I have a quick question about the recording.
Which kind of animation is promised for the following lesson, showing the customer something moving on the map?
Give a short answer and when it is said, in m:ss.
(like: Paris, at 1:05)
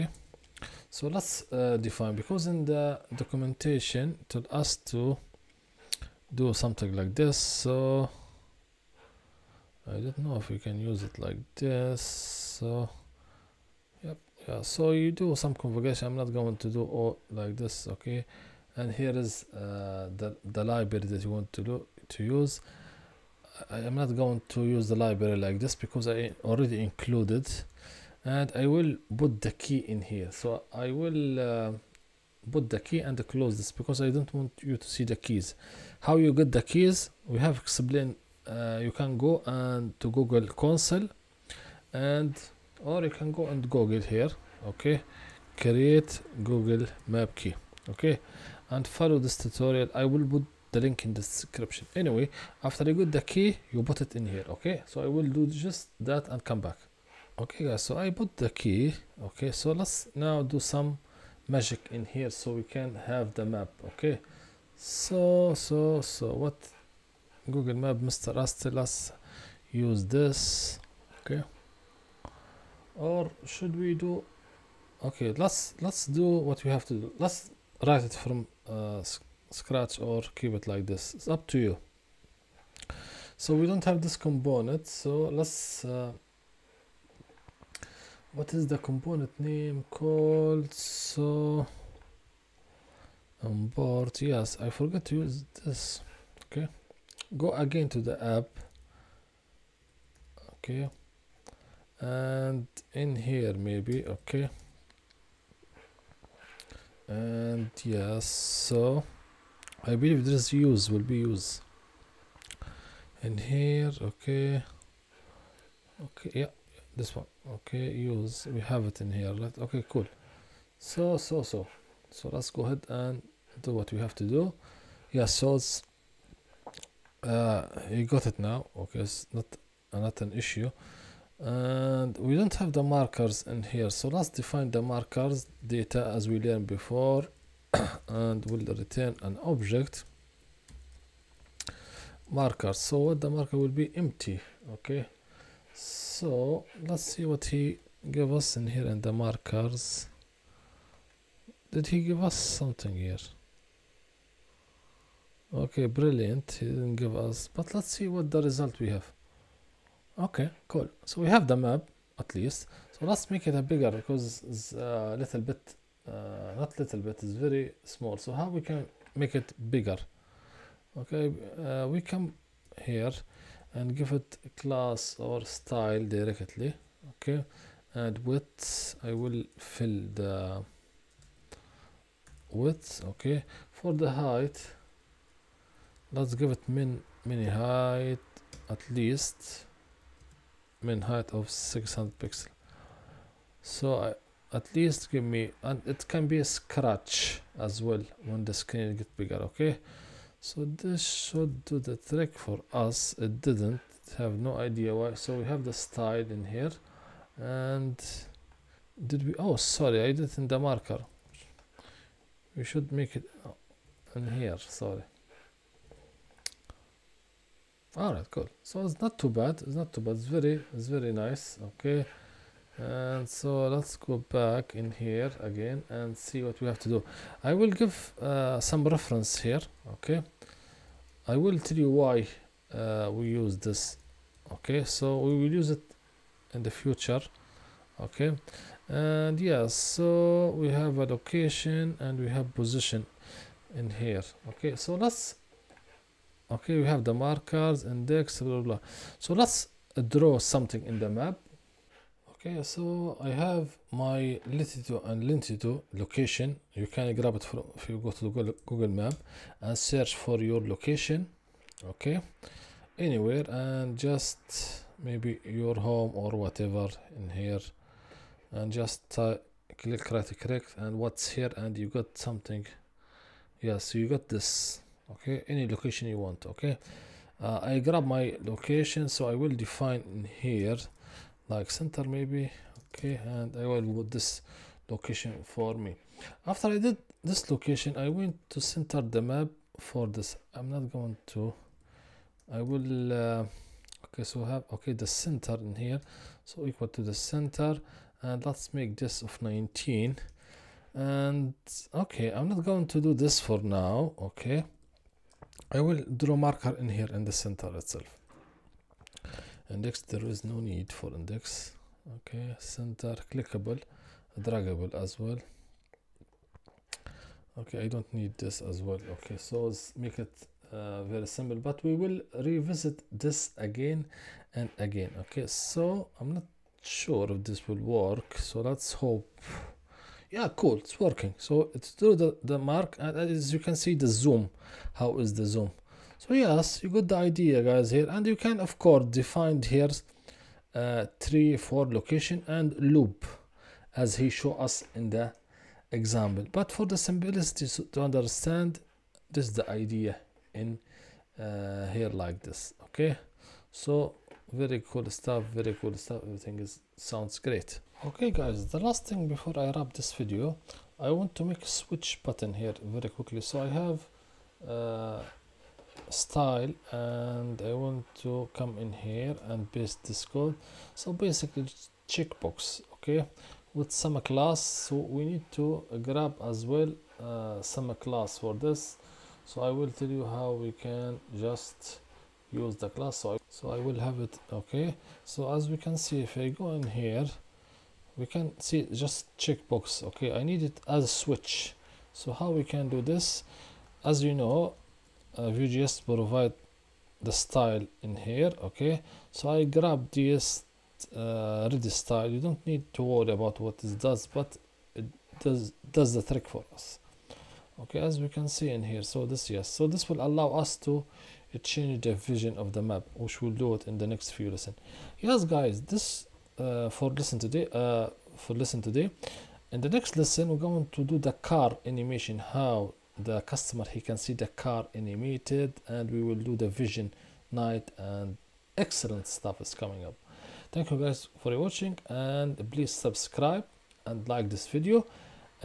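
car animation, at 7:01.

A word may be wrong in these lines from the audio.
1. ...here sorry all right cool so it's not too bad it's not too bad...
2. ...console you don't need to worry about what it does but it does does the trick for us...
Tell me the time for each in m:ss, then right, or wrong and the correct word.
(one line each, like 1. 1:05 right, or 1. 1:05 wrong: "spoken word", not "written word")
1. 3:34 right
2. 6:41 wrong: "style", not "console".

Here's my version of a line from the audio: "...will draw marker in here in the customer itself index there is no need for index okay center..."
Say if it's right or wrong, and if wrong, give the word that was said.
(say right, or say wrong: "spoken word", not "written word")
wrong: "center", not "customer".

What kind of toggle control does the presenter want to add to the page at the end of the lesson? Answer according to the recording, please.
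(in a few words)
switch button.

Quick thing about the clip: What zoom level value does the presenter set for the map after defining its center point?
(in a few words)
19.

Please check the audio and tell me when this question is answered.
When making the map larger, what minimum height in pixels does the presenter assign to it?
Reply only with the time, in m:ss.
3:11.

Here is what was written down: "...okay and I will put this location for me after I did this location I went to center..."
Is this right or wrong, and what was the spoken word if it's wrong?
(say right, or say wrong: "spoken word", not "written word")
right.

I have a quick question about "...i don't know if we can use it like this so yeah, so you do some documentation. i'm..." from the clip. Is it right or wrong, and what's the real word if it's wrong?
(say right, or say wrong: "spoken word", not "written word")
wrong: "configuration", not "documentation".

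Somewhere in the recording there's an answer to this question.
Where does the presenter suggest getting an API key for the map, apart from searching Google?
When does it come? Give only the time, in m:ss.
0:40.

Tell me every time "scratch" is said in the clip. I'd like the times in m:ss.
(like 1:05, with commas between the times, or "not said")
1:19, 3:16.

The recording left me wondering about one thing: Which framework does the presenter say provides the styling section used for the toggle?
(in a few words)
Vue.js.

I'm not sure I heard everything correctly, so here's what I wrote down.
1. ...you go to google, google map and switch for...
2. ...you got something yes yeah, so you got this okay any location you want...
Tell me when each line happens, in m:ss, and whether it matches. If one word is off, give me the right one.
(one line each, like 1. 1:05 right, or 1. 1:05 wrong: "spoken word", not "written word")
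1. 4:17 wrong: "search", not "switch"
2. 4:31 right.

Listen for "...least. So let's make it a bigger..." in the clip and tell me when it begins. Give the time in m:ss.
2:42.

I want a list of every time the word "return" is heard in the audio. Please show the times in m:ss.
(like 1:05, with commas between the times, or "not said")
2:18.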